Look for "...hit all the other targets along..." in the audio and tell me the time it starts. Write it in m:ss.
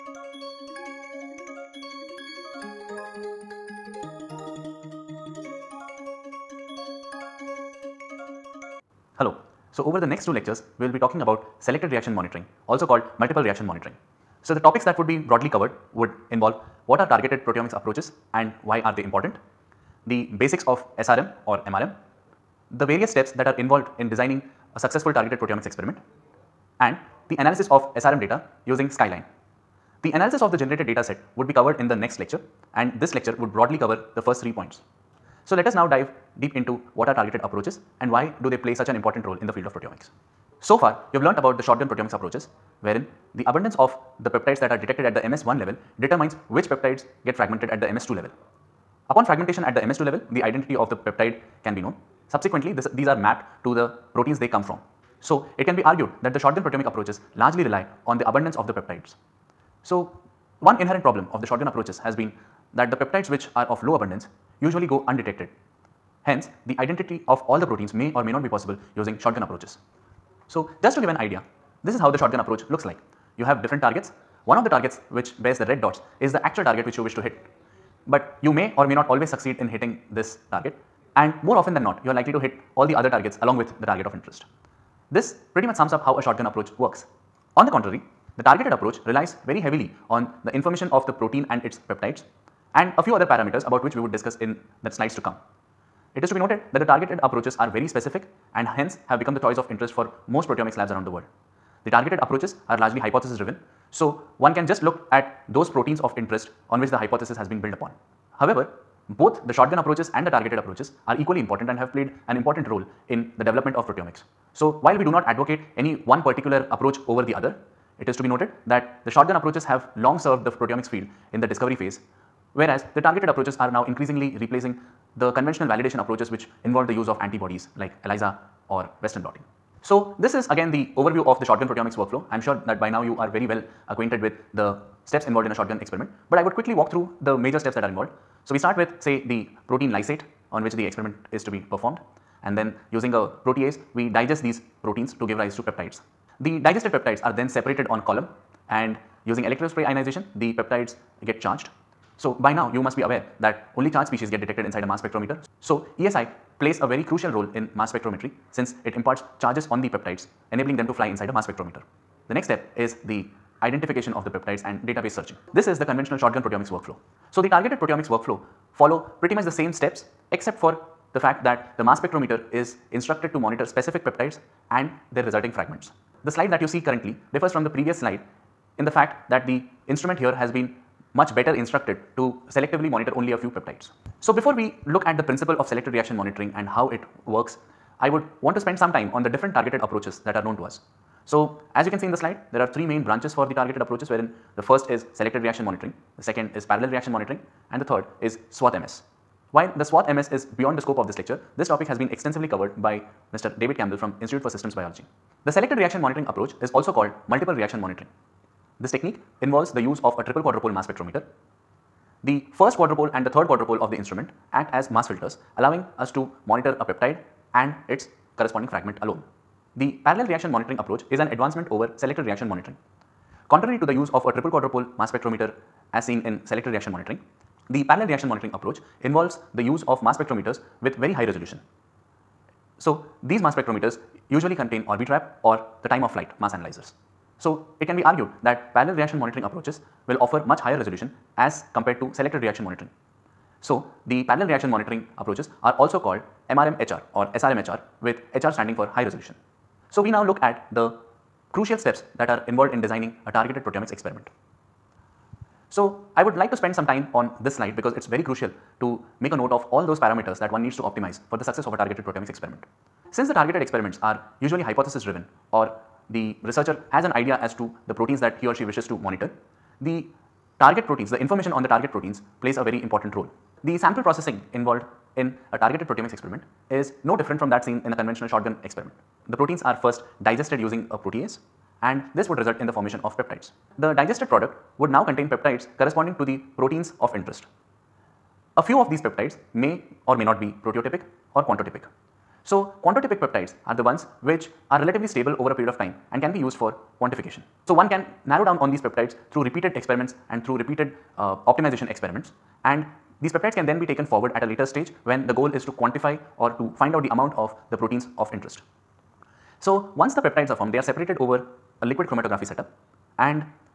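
1:22.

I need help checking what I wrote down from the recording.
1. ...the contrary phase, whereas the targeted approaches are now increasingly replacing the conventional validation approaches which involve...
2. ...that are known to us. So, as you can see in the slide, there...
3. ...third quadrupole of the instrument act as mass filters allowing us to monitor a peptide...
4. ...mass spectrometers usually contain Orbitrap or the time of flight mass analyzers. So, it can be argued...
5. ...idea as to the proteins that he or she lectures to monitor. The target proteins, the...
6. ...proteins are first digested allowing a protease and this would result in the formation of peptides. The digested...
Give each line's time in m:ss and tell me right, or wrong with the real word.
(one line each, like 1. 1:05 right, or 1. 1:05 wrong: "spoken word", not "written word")
1. 2:01 wrong: "discovery", not "contrary"
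2. 3:10 right
3. 3:33 right
4. 3:53 right
5. 4:27 wrong: "wishes", not "lectures"
6. 4:39 wrong: "using", not "allowing".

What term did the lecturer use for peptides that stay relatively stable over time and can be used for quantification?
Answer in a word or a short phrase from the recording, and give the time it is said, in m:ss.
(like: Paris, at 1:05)
Quantotypic peptides, at 4:52.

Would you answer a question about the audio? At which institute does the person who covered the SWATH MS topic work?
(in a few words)
Institute for Systems Biology.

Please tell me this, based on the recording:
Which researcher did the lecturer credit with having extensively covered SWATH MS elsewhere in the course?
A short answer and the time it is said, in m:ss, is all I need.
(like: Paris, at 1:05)
David Campbell, at 3:23.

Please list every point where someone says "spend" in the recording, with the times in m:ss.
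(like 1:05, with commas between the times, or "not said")
3:08, 4:16.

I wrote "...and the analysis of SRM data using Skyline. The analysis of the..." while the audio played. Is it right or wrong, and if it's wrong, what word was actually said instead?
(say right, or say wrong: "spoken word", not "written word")
right.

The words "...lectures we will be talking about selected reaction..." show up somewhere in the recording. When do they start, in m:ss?
0:10.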